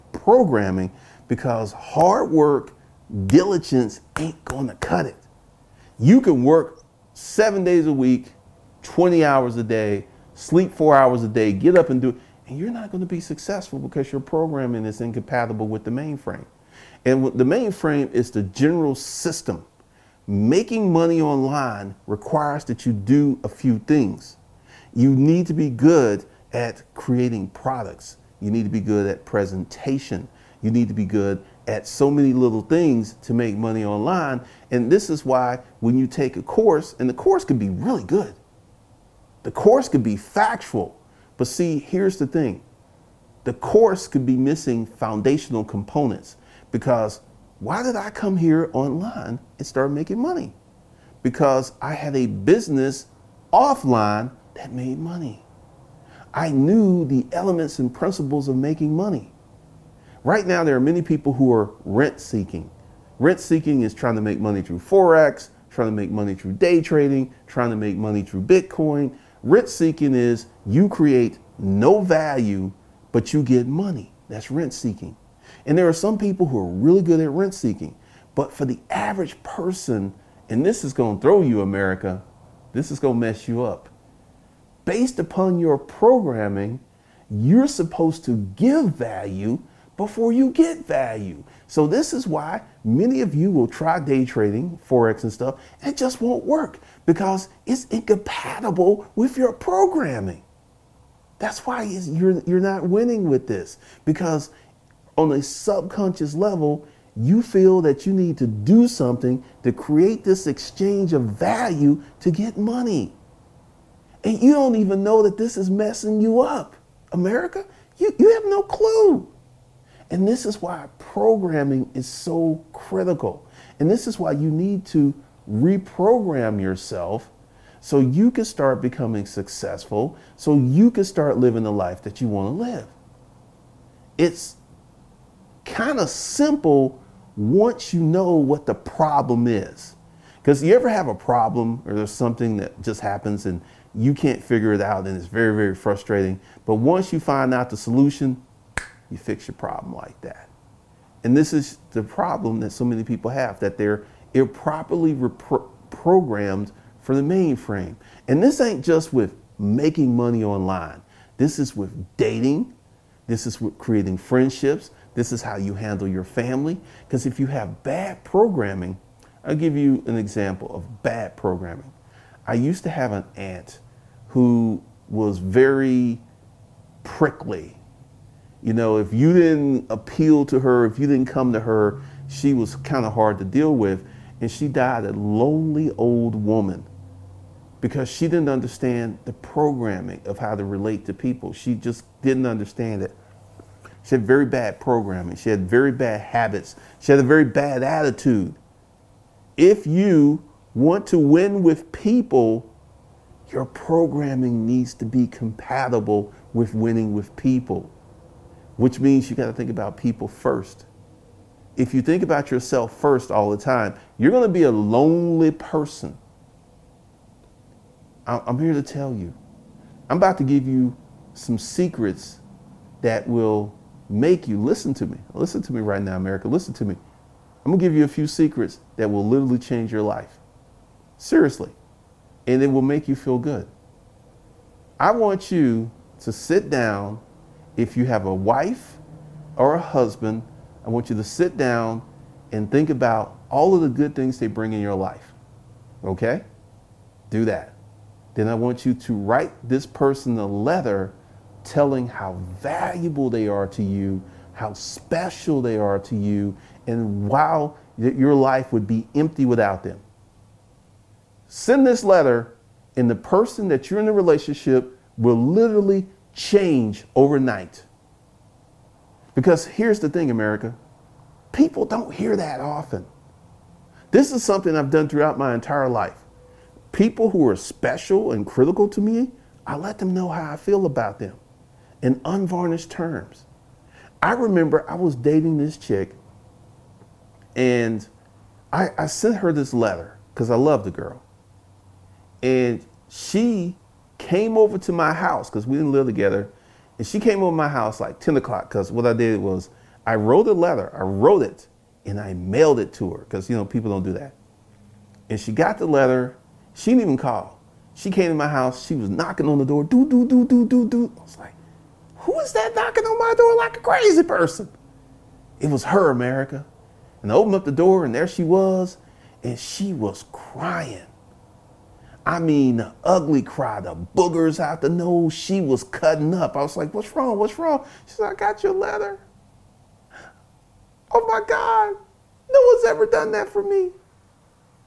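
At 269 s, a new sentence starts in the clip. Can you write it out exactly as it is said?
Because here's the thing, America people don't hear that often.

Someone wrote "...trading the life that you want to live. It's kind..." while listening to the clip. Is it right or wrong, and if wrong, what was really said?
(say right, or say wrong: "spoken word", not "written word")
wrong: "living", not "trading".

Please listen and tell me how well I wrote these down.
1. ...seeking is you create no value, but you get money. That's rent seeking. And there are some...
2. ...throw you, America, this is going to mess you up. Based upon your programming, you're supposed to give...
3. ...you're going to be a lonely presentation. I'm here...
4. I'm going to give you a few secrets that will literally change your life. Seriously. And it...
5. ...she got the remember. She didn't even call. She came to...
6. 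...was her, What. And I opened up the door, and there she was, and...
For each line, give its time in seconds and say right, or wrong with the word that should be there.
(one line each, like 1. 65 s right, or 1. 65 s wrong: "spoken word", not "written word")
1. 69 s right
2. 81 s right
3. 214 s wrong: "person", not "presentation"
4. 227 s right
5. 305 s wrong: "letter", not "remember"
6. 315 s wrong: "America", not "What".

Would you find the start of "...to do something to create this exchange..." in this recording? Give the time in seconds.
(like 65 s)
108 s.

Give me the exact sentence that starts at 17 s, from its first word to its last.
And the mainframe is the general system.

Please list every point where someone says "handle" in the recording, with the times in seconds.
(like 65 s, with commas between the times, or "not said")
165 s.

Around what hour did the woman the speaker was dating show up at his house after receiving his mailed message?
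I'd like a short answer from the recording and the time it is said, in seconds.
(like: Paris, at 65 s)
10 o'clock, at 298 s.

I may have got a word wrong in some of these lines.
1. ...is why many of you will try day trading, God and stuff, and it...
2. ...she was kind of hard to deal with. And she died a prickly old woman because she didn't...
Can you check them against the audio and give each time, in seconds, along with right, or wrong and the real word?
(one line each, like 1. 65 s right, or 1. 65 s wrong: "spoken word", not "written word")
1. 92 s wrong: "Forex", not "God"
2. 182 s wrong: "lonely", not "prickly".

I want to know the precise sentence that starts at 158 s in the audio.
And this ain't just with making money online.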